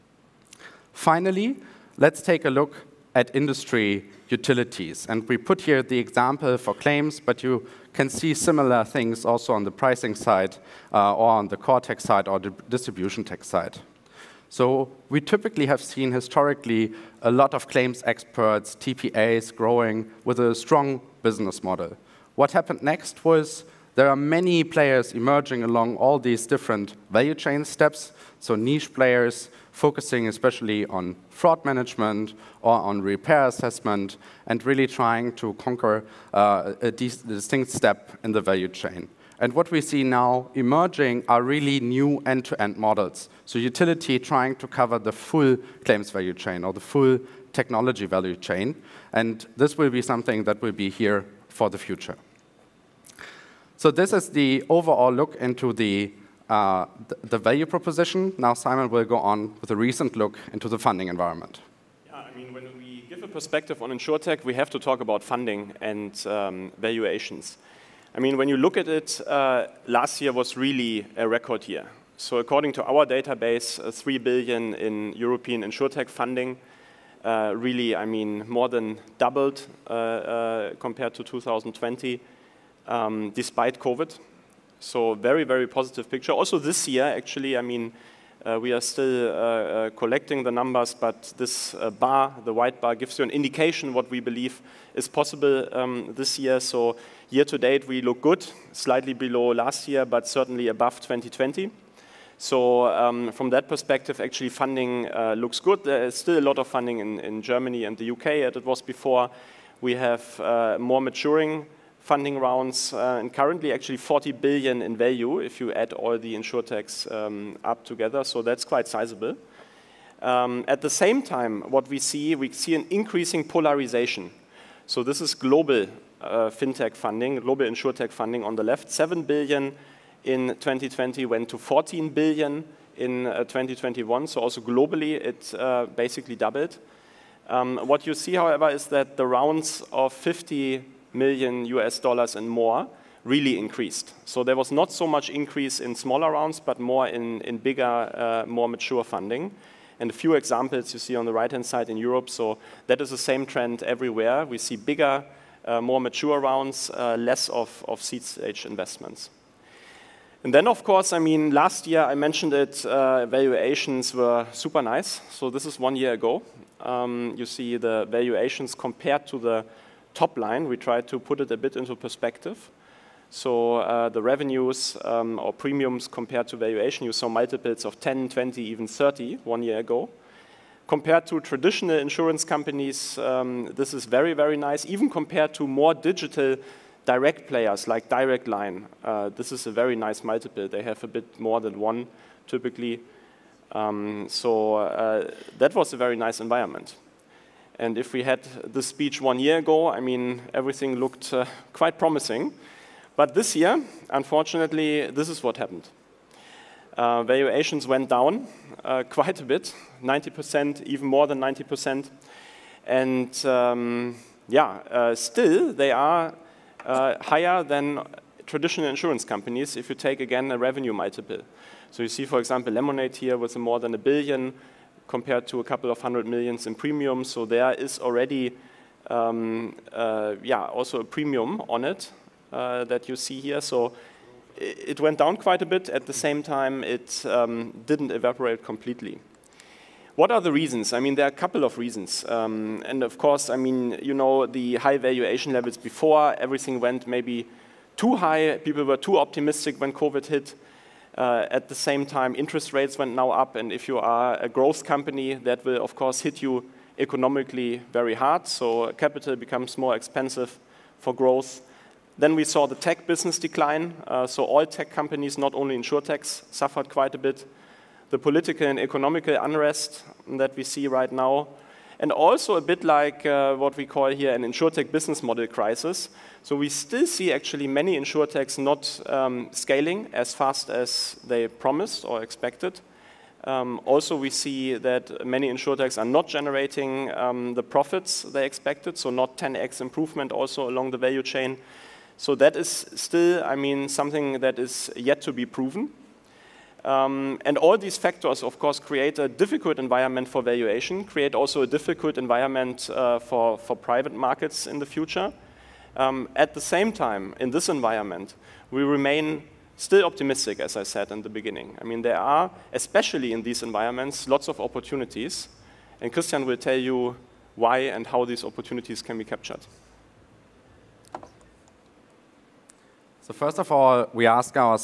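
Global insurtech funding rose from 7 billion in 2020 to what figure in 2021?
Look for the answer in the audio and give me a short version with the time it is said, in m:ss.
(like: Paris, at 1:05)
14 billion, at 2:11.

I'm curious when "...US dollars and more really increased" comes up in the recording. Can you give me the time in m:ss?
2:21.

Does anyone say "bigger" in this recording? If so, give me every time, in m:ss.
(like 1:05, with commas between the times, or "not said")
2:27, 2:34.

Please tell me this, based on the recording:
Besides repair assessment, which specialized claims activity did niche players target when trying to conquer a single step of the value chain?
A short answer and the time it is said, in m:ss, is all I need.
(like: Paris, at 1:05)
fraud management, at 0:31.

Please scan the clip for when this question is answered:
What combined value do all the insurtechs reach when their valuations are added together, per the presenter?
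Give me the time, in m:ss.
1:53.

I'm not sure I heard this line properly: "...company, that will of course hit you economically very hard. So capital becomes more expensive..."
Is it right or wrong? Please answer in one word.
right.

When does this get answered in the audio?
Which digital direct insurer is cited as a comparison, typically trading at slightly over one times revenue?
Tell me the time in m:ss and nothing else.
3:08.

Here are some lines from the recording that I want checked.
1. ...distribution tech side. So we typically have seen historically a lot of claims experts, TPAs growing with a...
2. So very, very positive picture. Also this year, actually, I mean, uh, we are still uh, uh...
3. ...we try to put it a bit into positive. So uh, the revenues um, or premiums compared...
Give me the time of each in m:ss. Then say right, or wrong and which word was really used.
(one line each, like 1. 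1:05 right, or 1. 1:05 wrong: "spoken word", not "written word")
1. 0:12 right
2. 1:24 right
3. 2:50 wrong: "perspective", not "positive".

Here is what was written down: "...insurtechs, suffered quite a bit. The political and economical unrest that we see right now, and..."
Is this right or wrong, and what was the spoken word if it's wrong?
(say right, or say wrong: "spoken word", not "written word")
right.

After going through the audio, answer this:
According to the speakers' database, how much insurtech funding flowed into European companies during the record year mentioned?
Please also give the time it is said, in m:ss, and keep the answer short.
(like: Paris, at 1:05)
3 billion, at 1:13.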